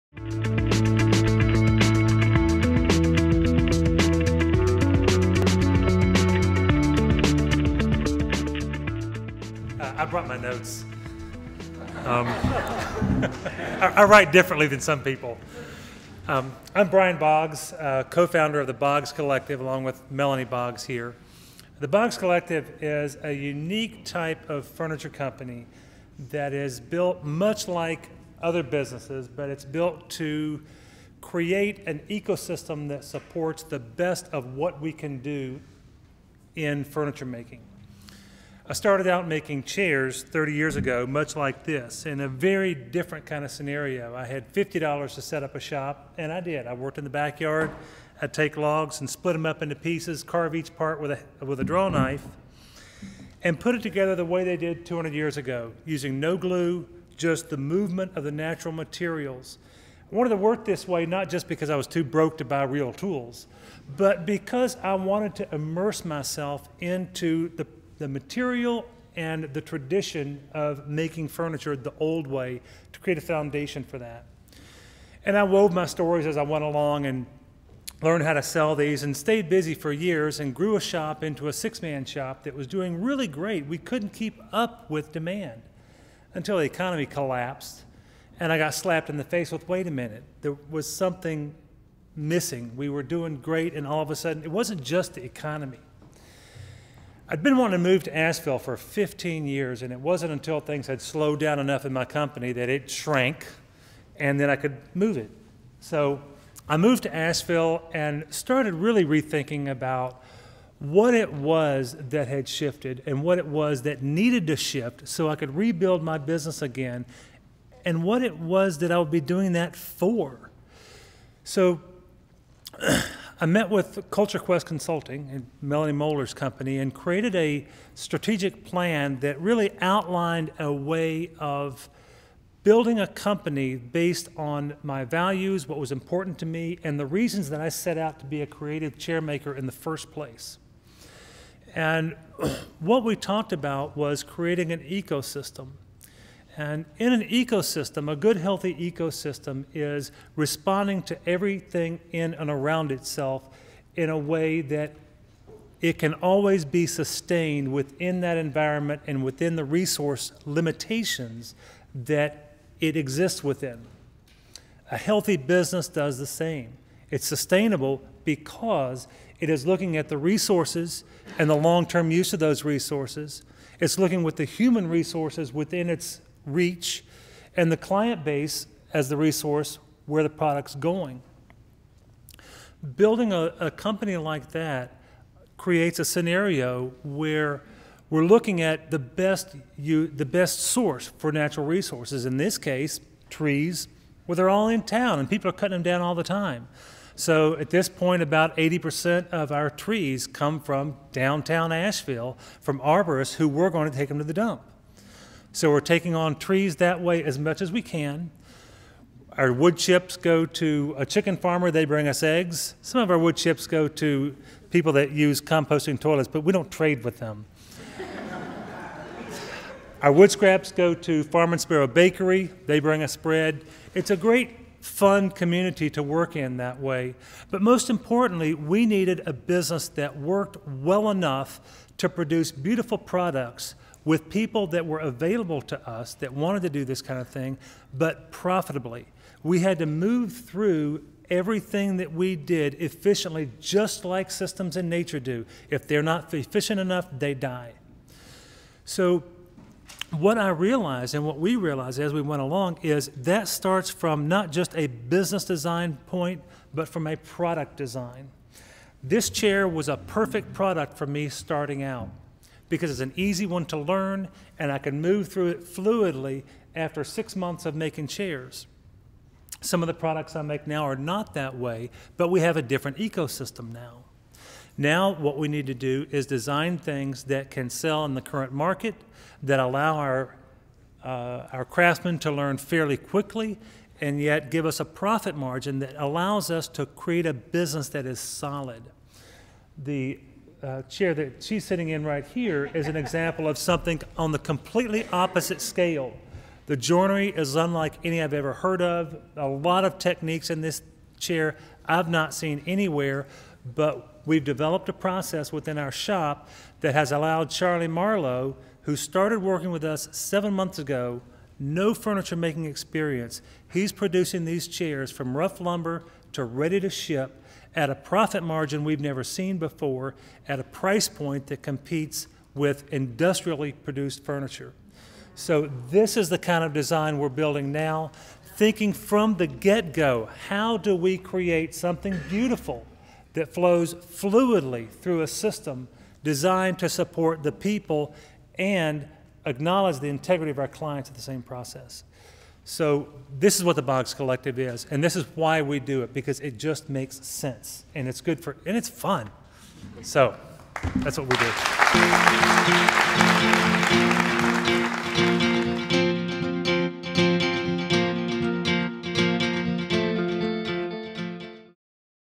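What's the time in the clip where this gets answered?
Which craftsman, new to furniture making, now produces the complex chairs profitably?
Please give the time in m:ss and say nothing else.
5:07.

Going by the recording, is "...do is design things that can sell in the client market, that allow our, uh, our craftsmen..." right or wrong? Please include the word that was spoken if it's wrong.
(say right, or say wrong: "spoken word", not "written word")
wrong: "current", not "client".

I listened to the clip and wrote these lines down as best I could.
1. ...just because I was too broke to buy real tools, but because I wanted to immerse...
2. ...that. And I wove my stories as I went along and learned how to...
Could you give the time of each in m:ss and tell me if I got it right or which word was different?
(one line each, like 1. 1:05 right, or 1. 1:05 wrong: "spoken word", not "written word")
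1. 1:01 right
2. 1:13 right.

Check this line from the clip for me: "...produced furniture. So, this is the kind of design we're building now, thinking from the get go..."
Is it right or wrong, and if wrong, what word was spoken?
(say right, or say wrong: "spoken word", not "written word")
right.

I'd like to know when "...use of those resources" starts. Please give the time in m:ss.
2:52.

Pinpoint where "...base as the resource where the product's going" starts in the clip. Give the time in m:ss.
2:58.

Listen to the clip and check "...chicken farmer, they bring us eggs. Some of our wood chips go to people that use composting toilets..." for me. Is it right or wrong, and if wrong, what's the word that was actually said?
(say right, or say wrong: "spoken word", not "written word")
right.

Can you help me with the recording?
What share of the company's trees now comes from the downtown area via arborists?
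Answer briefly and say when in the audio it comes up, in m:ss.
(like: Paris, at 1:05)
80%, at 3:18.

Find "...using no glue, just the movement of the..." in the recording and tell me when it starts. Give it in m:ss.
0:55.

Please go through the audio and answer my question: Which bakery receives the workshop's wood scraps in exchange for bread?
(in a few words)
Farm and Sparrow Bakery.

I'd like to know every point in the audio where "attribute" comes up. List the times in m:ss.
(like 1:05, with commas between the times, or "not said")
not said.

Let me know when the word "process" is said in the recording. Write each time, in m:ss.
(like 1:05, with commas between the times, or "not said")
5:04, 5:41.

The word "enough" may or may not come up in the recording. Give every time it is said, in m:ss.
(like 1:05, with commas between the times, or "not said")
1:41, 3:51, 4:06.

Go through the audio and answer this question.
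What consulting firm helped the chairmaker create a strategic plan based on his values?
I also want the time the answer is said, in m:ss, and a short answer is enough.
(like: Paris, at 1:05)
Culture Quest Consulting, at 2:04.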